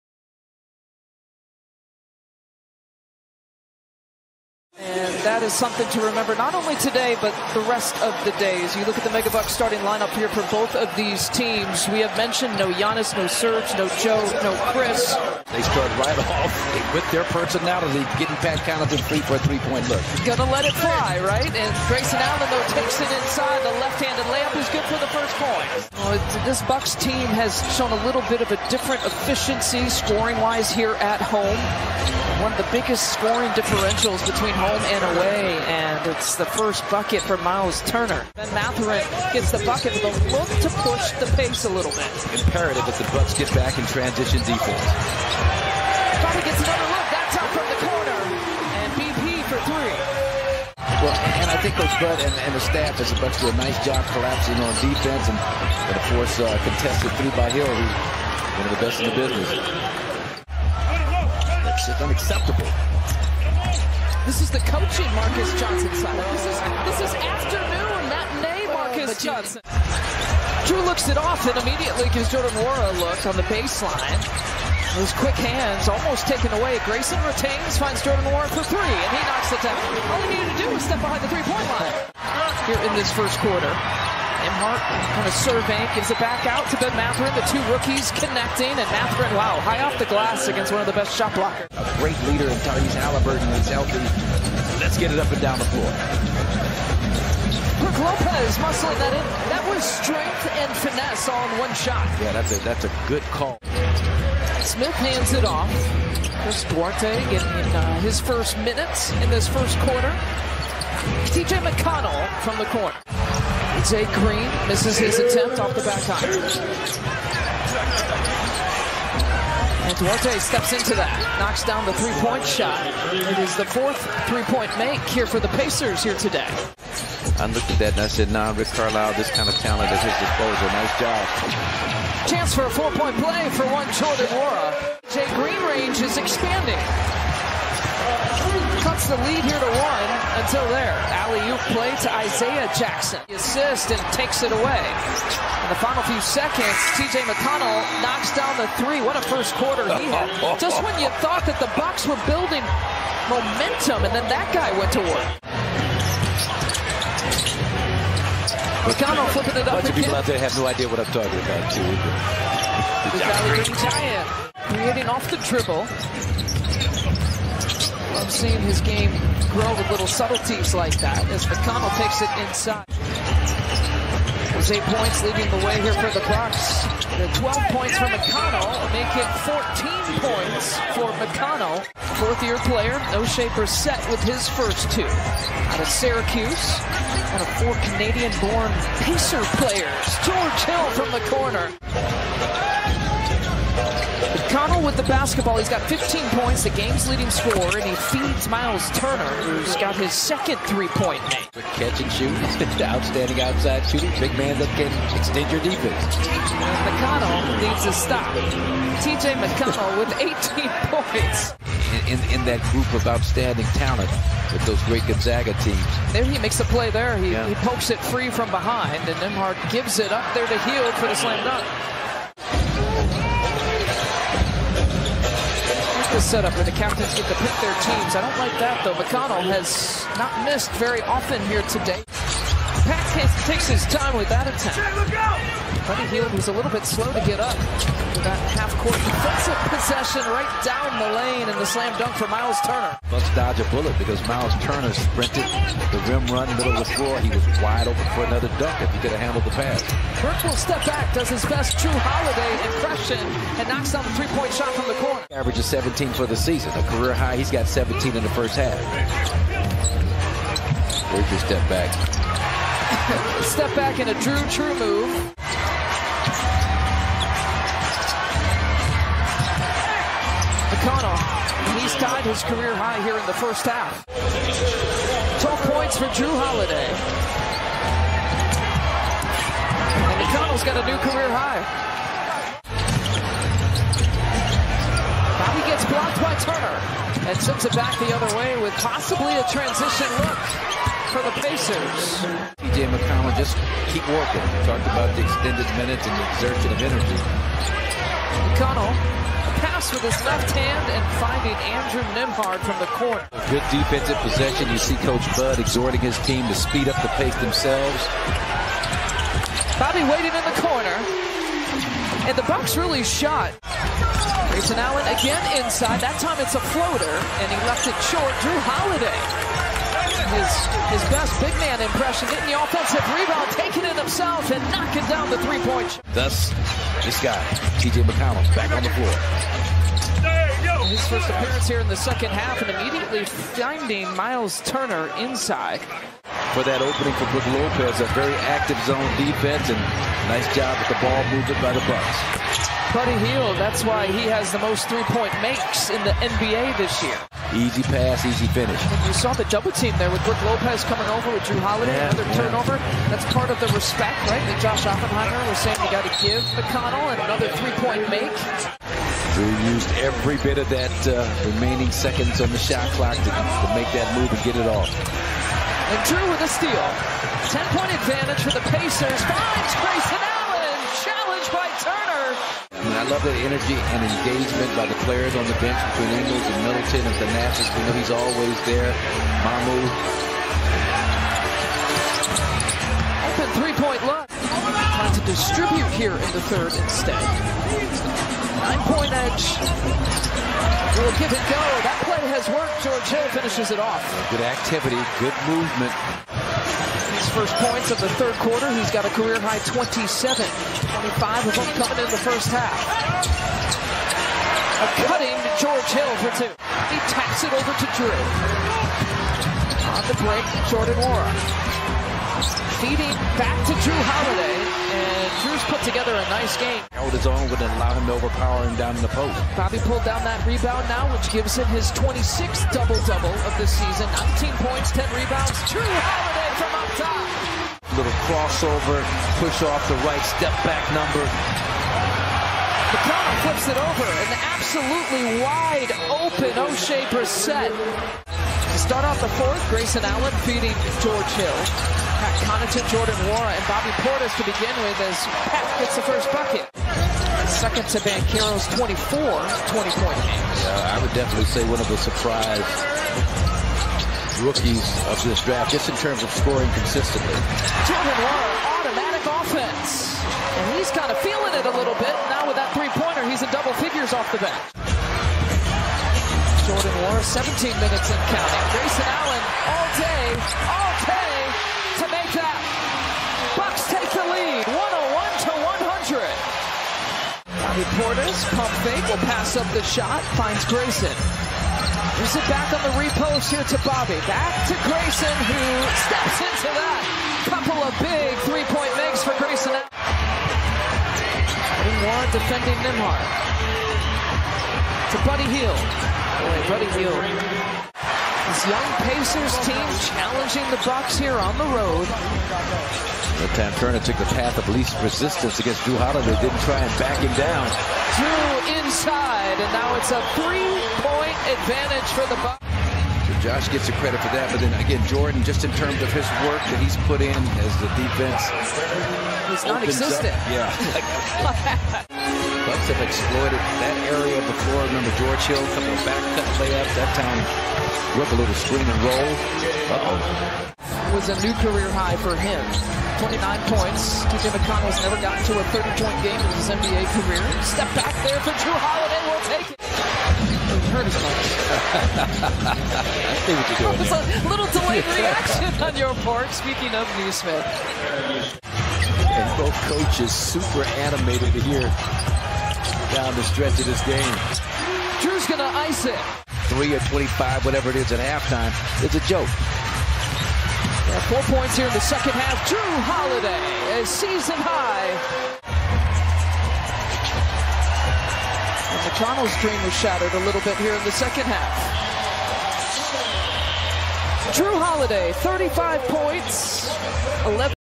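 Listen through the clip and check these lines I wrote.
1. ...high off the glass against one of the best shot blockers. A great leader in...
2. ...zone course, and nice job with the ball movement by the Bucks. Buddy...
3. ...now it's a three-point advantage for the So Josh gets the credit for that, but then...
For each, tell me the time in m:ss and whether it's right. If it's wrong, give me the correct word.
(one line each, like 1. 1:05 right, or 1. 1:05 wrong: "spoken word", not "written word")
1. 1:29 right
2. 5:38 wrong: "defense", not "course"
3. 8:29 right.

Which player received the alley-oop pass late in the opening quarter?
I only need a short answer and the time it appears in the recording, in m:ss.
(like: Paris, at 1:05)
Isaiah Jackson, at 2:22.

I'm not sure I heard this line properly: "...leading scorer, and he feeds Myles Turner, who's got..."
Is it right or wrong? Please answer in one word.
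right.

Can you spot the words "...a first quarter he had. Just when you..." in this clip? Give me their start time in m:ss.
2:29.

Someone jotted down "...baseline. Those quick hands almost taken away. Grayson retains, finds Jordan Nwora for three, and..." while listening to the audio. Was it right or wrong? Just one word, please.
right.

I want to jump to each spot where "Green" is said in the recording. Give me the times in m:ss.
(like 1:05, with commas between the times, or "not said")
1:54, 2:15.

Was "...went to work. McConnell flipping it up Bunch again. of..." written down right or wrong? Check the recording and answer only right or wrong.
right.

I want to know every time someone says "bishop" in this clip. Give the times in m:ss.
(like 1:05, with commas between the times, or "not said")
not said.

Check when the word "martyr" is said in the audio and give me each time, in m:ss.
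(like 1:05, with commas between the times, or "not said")
not said.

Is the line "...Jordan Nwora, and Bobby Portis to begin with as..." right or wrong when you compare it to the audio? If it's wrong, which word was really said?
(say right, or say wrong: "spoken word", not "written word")
right.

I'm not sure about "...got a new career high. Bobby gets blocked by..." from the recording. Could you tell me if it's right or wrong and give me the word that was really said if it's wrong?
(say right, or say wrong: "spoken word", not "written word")
right.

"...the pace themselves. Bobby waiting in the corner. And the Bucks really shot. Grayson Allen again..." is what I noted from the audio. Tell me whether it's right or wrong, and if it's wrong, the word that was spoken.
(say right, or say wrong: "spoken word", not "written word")
right.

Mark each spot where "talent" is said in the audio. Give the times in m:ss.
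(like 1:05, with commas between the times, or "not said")
2:09, 3:33.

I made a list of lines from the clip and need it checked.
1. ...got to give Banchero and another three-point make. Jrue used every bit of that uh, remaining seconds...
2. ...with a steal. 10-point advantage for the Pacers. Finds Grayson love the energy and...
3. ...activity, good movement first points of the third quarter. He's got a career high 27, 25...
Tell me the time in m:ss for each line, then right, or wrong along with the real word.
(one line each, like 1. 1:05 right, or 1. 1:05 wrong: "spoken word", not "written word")
1. 5:55 wrong: "McConnell", not "Banchero"
2. 6:06 right
3. 6:34 right.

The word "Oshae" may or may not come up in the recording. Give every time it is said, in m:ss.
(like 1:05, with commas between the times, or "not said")
3:03, 7:16.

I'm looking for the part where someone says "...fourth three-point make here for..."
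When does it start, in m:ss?
2:03.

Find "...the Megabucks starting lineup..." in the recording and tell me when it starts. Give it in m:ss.
0:09.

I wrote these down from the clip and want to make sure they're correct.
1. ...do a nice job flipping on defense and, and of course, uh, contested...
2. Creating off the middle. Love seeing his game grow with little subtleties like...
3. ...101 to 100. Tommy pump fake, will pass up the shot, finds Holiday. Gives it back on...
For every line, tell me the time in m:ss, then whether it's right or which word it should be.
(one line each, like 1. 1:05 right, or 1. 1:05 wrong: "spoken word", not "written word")
1. 0:53 wrong: "collapsing", not "flipping"
2. 2:44 wrong: "dribble", not "middle"
3. 7:54 wrong: "Grayson", not "Holiday".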